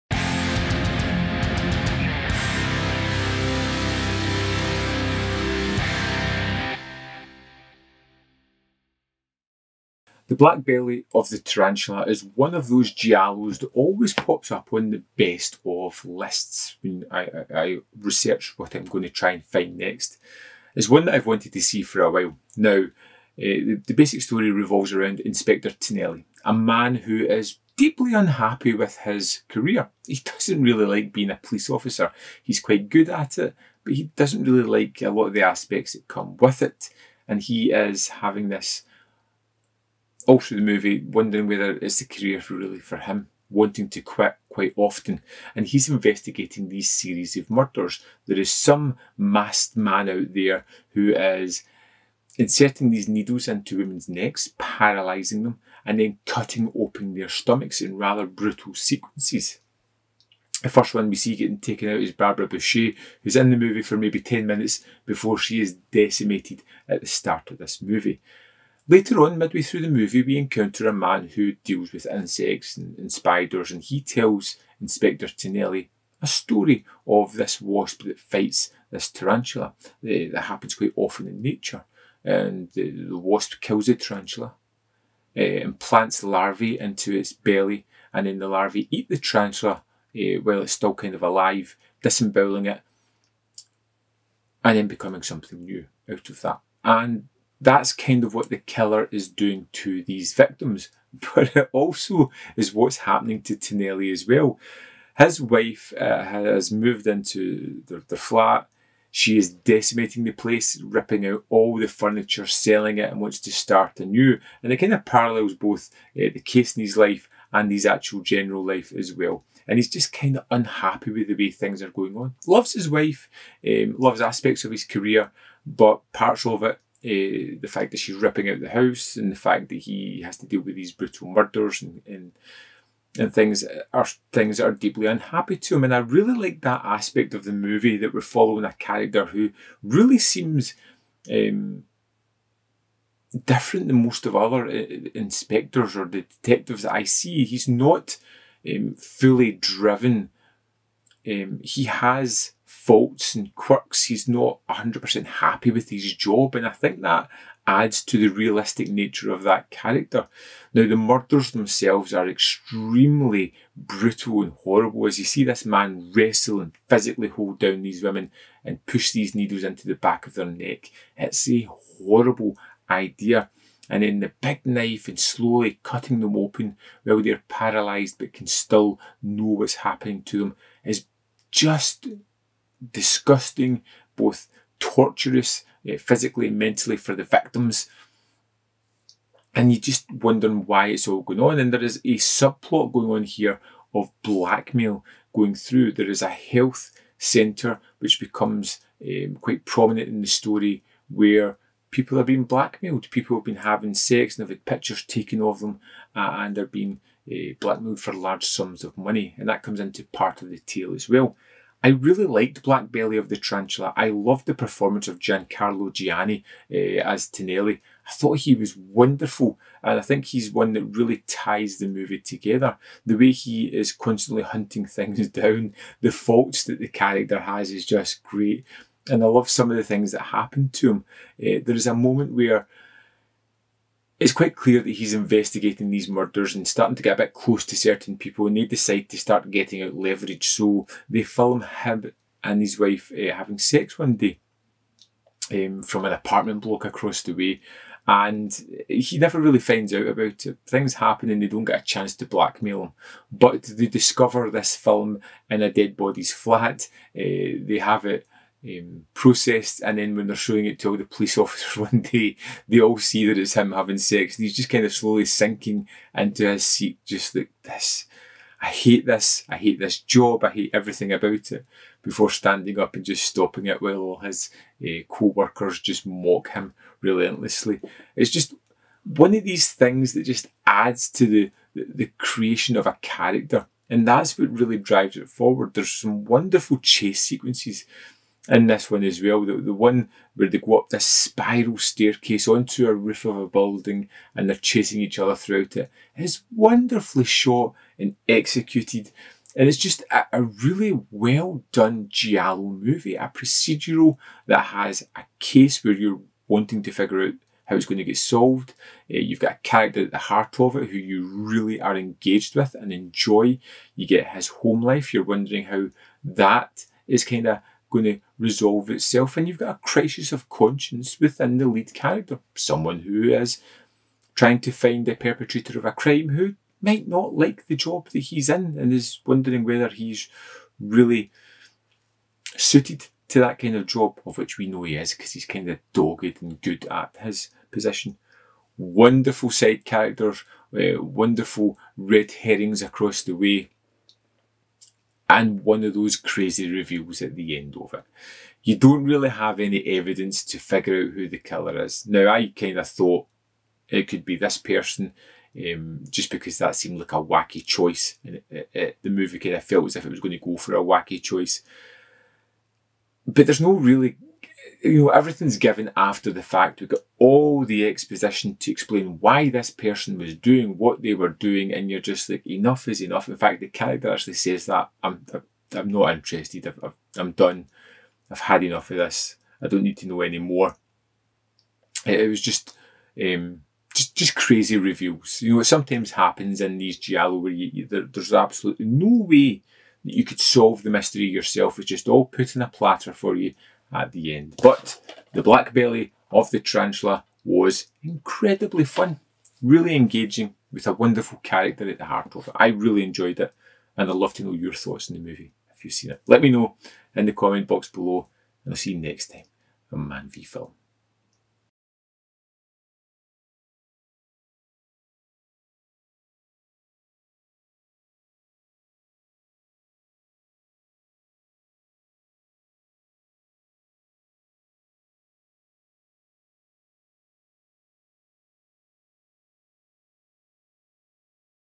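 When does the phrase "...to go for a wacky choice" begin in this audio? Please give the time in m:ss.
6:00.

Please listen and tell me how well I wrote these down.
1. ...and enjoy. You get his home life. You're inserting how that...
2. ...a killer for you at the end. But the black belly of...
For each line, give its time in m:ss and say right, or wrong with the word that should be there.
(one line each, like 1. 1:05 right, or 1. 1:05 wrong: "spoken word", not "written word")
1. 5:12 wrong: "wondering", not "inserting"
2. 6:32 wrong: "platter", not "killer".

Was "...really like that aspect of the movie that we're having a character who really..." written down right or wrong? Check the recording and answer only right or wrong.
wrong.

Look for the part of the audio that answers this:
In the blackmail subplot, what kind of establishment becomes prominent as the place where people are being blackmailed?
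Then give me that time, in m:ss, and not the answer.
3:16.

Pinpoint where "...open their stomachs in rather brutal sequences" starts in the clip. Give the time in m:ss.
0:56.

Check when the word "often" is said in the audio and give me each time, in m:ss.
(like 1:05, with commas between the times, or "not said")
0:44, 1:20.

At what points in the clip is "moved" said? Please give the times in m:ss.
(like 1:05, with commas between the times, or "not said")
1:46.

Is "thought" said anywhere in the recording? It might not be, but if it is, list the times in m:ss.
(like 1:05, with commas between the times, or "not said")
3:38, 5:52, 6:44.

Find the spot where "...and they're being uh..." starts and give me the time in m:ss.
3:26.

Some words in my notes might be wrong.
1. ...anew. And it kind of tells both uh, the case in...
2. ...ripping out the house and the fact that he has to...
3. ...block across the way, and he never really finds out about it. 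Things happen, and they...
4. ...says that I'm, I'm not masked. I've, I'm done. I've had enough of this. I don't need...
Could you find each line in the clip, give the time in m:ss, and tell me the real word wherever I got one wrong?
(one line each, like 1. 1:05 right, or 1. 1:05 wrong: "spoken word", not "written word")
1. 1:53 wrong: "parallels", not "tells"
2. 2:08 right
3. 4:06 right
4. 6:14 wrong: "interested", not "masked".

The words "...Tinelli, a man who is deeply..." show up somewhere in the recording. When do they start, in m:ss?
0:25.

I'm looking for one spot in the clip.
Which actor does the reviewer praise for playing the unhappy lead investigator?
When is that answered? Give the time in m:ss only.
3:35.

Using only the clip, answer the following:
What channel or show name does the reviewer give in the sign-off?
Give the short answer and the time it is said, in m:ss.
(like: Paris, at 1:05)
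Man v Film, at 6:50.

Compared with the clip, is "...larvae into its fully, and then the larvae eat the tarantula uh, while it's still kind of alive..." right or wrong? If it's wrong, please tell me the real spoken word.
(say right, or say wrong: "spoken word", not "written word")
wrong: "belly", not "fully".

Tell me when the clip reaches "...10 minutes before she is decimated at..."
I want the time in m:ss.
1:04.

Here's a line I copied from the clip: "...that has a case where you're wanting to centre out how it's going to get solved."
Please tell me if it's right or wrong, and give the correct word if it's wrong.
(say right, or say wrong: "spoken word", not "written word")
wrong: "figure", not "centre".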